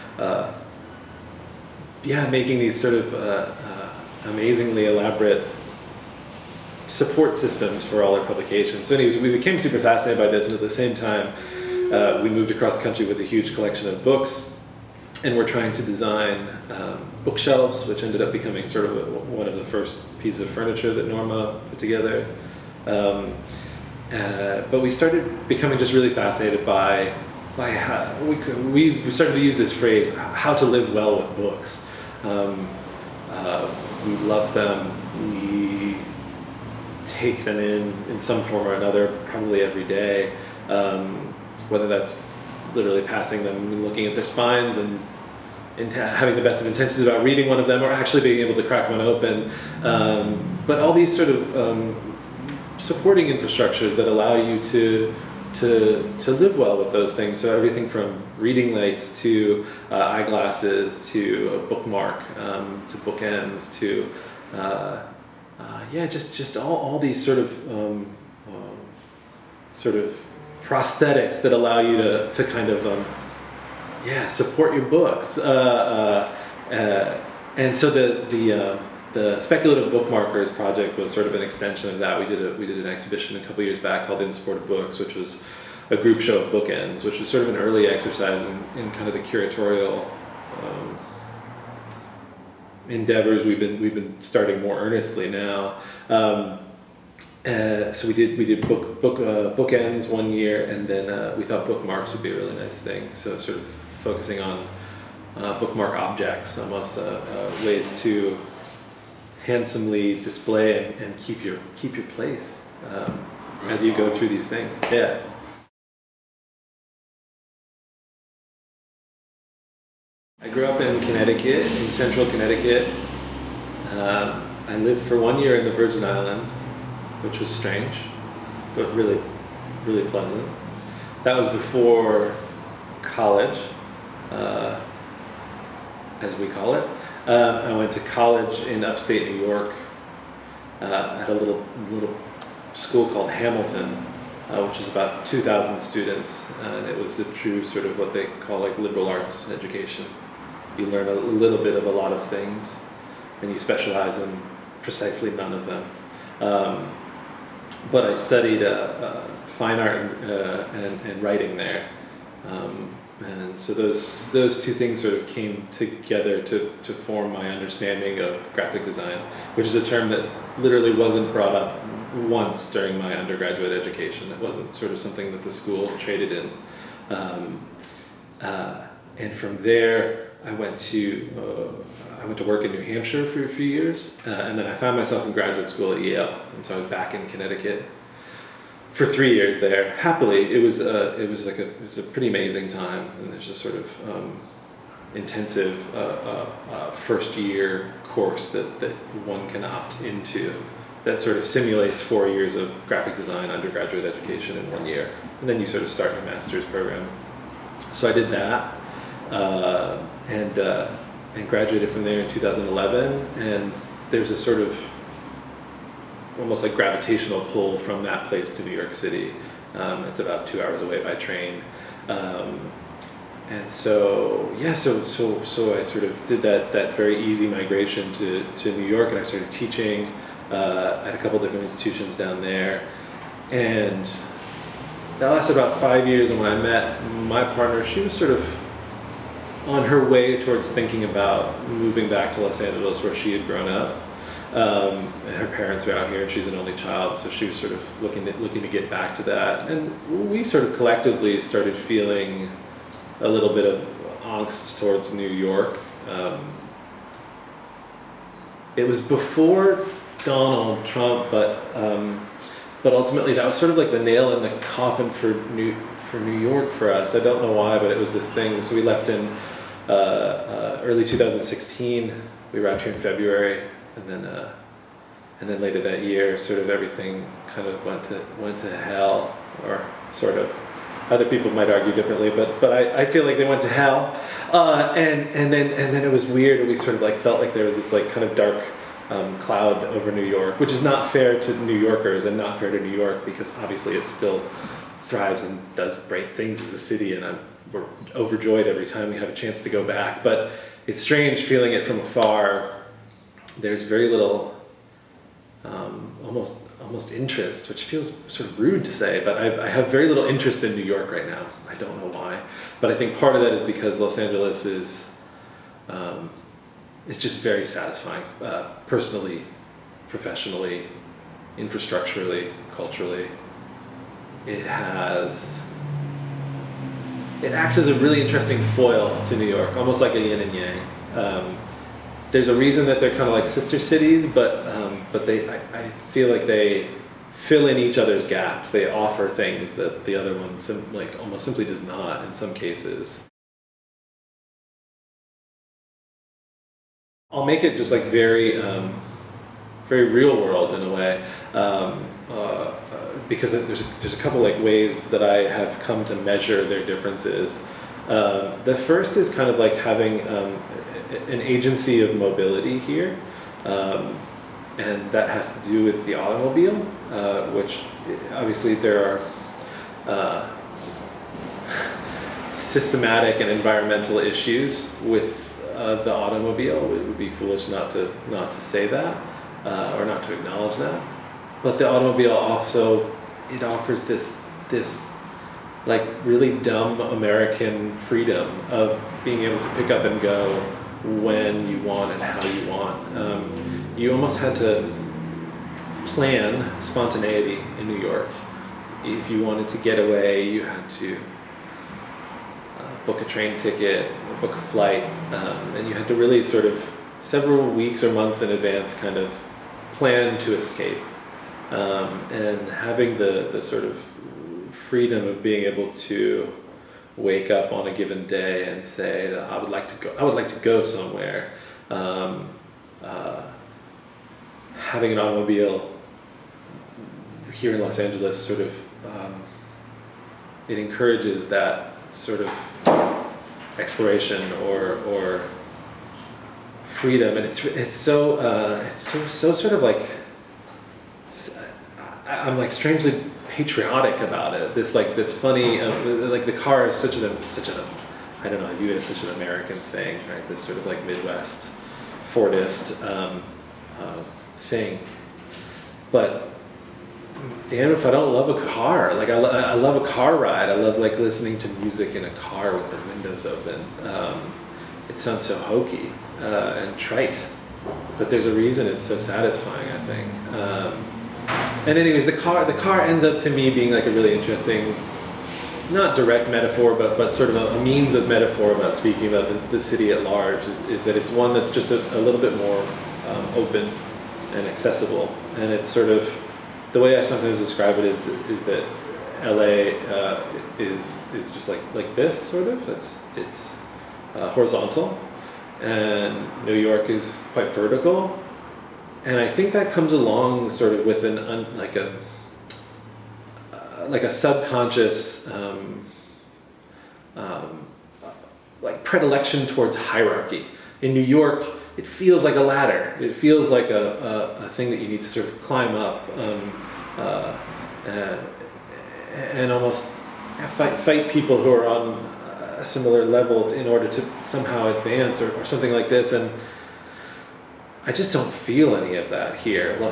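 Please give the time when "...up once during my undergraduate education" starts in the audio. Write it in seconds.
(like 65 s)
171 s.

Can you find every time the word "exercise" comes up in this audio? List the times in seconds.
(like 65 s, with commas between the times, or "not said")
87 s.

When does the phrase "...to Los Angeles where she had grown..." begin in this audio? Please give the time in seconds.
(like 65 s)
242 s.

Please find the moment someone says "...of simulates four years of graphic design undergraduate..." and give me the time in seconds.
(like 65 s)
201 s.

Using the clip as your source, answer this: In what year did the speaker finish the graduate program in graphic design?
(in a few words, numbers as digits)
2011.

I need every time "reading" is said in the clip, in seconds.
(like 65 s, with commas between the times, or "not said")
47 s, 58 s.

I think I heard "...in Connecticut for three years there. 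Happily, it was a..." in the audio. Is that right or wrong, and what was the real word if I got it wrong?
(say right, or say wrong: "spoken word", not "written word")
right.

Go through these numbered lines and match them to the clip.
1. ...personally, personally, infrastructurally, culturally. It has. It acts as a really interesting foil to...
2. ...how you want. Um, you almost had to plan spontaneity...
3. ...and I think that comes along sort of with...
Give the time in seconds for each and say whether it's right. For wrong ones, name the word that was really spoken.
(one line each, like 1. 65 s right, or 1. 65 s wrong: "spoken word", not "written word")
1. 318 s wrong: "professionally", not "personally"
2. 392 s right
3. 499 s right.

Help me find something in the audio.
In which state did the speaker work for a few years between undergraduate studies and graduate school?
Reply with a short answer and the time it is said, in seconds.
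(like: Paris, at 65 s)
New Hampshire, at 182 s.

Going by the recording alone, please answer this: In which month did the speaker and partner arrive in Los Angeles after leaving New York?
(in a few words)
February.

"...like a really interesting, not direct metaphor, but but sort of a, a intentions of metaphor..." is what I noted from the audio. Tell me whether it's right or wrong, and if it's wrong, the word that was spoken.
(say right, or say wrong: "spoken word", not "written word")
wrong: "means", not "intentions".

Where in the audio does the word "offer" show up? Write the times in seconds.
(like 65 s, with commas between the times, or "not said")
338 s, 383 s.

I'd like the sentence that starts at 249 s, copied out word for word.
And we sort of collectively started feeling a little bit of angst towards New York.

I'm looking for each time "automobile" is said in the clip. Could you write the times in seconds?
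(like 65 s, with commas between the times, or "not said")
366 s, 376 s, 381 s, 425 s.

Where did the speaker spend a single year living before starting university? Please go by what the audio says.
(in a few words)
Virgin Islands.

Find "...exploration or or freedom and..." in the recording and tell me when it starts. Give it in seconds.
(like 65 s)
433 s.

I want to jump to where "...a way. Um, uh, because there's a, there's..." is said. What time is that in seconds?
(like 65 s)
350 s.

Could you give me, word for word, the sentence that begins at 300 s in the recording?
But it's strange feeling it from afar.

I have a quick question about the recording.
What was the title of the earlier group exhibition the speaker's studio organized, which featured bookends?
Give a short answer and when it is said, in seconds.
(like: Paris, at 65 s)
In Support of Books, at 84 s.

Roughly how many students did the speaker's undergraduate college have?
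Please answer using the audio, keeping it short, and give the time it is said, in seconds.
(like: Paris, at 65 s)
2,000, at 145 s.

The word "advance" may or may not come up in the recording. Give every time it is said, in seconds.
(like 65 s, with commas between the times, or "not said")
408 s, 524 s.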